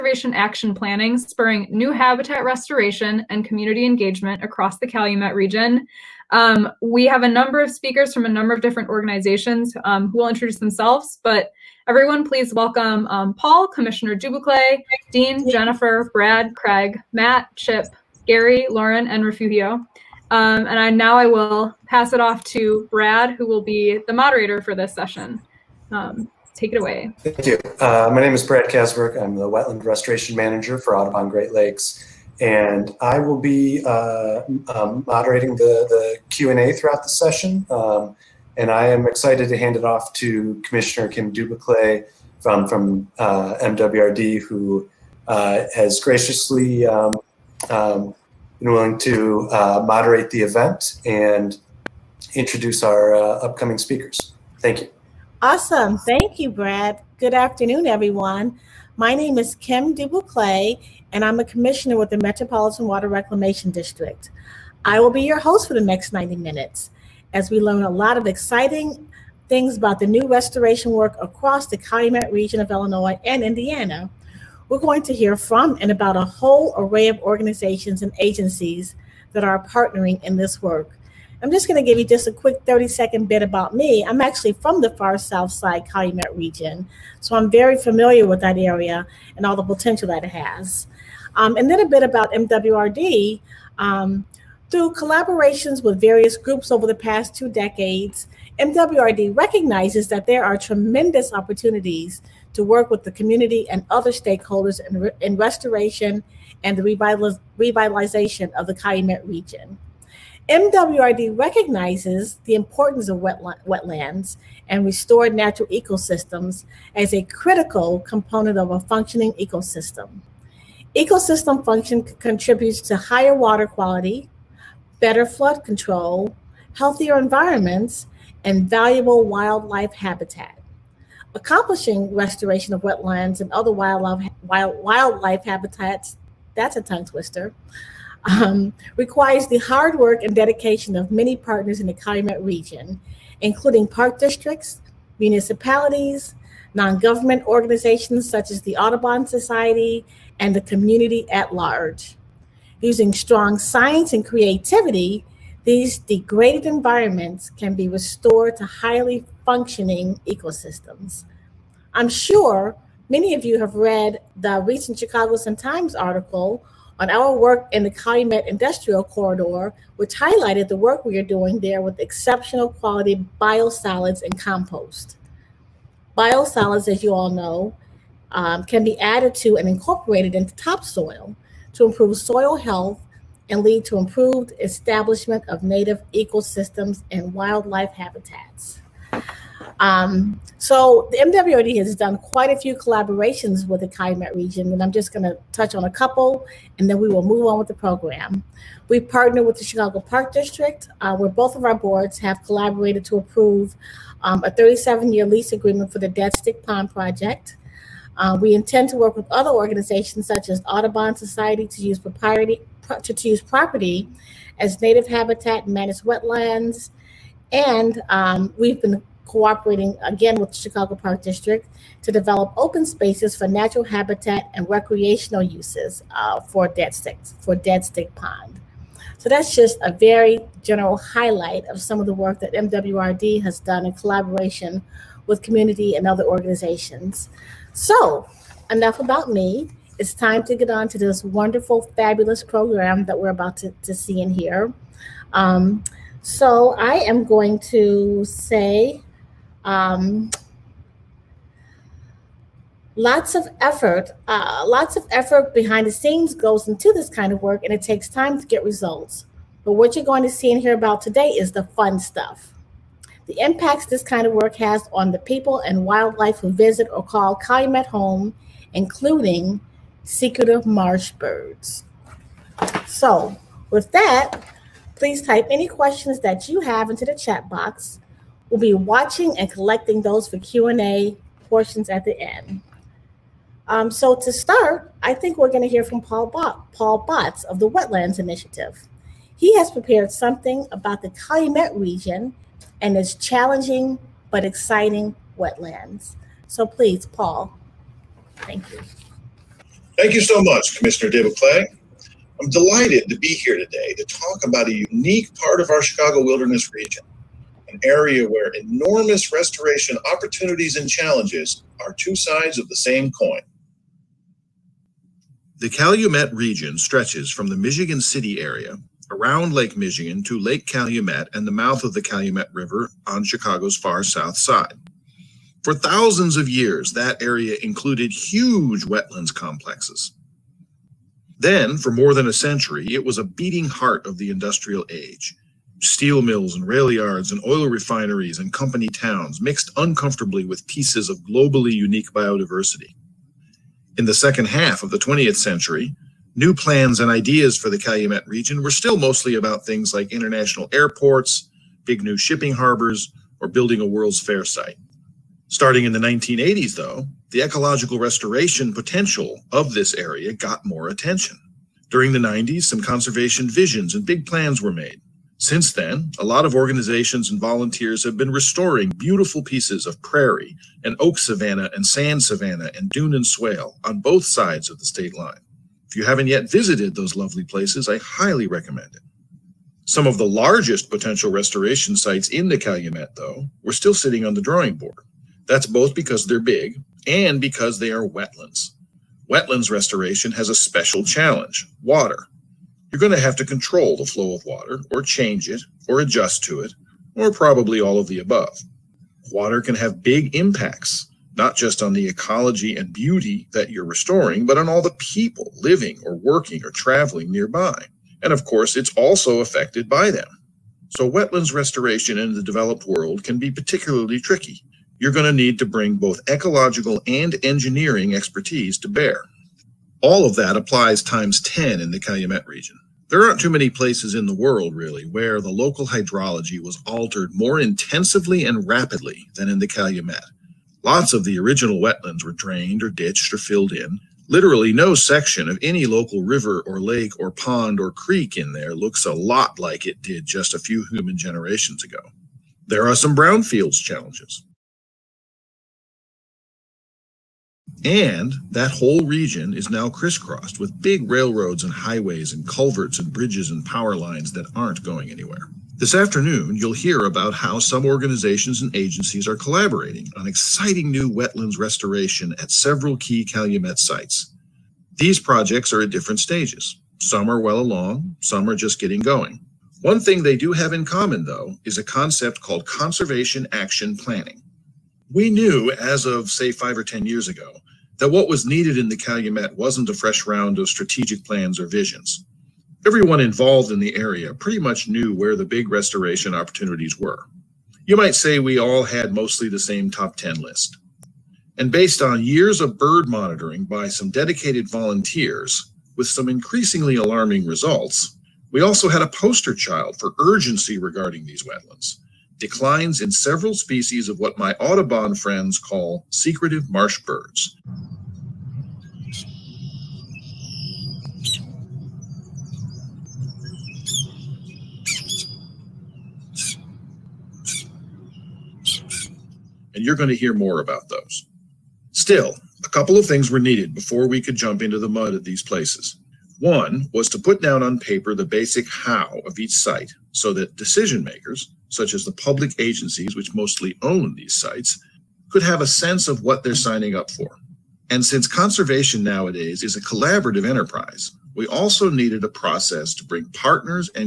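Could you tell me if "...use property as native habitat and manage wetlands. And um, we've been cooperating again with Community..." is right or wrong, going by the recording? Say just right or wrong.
wrong.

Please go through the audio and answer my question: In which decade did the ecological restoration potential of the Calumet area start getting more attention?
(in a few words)
1980s.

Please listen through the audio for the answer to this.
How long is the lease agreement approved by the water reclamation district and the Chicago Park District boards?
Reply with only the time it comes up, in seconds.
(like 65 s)
204 s.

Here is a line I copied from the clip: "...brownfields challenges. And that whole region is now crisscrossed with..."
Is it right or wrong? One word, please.
right.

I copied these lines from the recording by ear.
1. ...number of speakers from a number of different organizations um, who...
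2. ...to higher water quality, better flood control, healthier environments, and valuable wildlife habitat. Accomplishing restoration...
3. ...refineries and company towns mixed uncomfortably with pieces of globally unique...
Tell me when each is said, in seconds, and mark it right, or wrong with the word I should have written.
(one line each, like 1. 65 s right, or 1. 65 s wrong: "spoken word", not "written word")
1. 7 s right
2. 122 s right
3. 337 s right.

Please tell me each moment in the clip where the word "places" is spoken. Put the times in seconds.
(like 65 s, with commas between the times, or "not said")
377 s, 423 s, 525 s.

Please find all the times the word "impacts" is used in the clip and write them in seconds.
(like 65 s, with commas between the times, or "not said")
263 s, 400 s.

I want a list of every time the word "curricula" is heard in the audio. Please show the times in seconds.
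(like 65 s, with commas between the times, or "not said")
not said.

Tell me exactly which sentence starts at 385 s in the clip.
That's both because they're big and because they are wetlands.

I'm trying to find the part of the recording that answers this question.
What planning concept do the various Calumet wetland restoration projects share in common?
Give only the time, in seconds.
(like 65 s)
472 s.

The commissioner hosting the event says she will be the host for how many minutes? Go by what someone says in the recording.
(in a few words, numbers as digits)
90.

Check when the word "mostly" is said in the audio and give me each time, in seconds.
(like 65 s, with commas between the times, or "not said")
348 s, 489 s, 533 s.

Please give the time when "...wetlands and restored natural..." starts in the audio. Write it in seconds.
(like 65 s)
113 s.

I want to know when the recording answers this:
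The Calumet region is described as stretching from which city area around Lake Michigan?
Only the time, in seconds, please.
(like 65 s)
317 s.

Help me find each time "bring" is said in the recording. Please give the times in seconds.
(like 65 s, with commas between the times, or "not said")
415 s, 543 s.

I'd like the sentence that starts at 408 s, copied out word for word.
And of course, it's also affected by them.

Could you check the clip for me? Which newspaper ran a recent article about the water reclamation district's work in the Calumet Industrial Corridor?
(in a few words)
Chicago Sun-Times.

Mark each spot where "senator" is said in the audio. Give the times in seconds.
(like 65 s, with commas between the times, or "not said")
not said.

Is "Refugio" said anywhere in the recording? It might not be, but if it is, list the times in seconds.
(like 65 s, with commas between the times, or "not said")
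19 s.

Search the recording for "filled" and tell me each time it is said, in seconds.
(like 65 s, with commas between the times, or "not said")
433 s.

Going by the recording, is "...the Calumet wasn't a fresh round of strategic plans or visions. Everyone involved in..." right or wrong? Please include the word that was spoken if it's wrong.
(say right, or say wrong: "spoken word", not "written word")
right.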